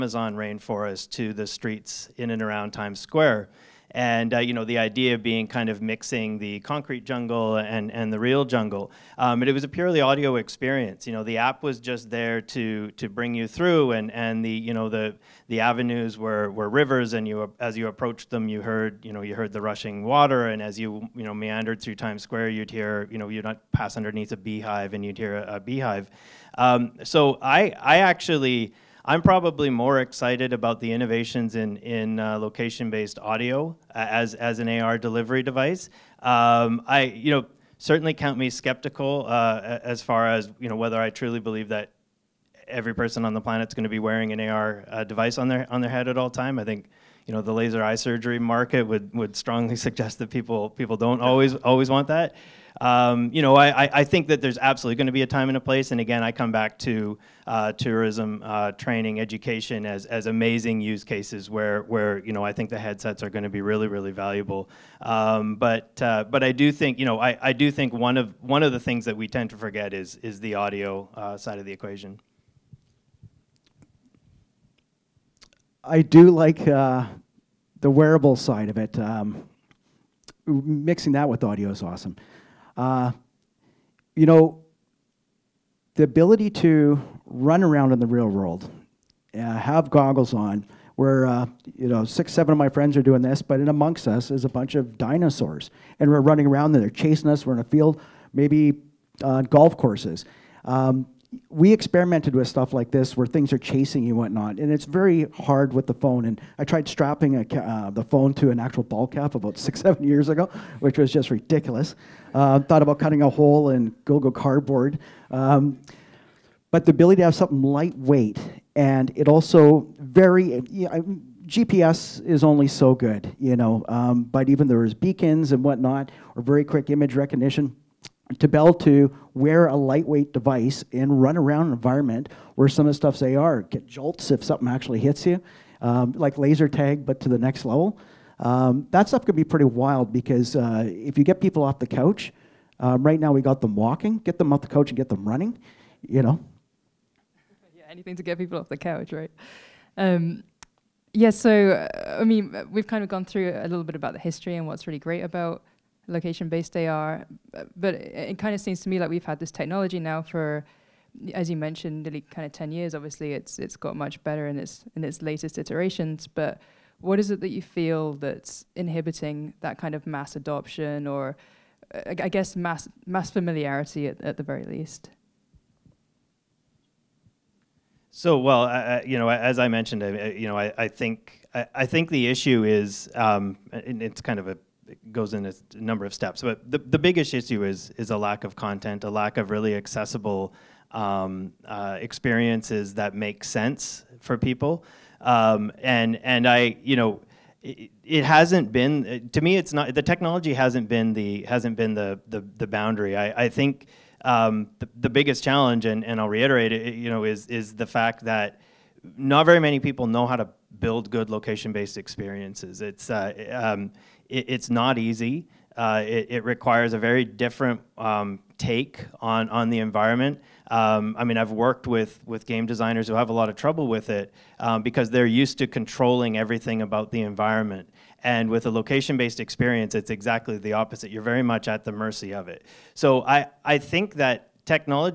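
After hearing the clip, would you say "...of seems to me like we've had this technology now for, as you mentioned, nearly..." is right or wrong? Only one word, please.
right.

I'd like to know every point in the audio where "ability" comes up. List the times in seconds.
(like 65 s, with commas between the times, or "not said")
86 s, 116 s.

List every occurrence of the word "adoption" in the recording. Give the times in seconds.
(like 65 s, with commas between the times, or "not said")
170 s.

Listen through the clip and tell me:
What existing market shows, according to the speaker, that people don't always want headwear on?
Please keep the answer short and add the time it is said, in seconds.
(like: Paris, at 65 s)
Laser eye surgery, at 47 s.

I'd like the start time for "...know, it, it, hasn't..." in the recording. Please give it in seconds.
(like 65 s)
196 s.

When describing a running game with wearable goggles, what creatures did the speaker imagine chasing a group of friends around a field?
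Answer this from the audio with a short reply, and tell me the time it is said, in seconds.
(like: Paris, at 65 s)
Dinosaurs, at 94 s.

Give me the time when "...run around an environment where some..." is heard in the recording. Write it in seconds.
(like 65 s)
131 s.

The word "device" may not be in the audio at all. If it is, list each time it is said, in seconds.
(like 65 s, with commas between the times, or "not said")
35 s, 45 s, 130 s.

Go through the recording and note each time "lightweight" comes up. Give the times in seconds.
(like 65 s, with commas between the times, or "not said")
117 s, 129 s.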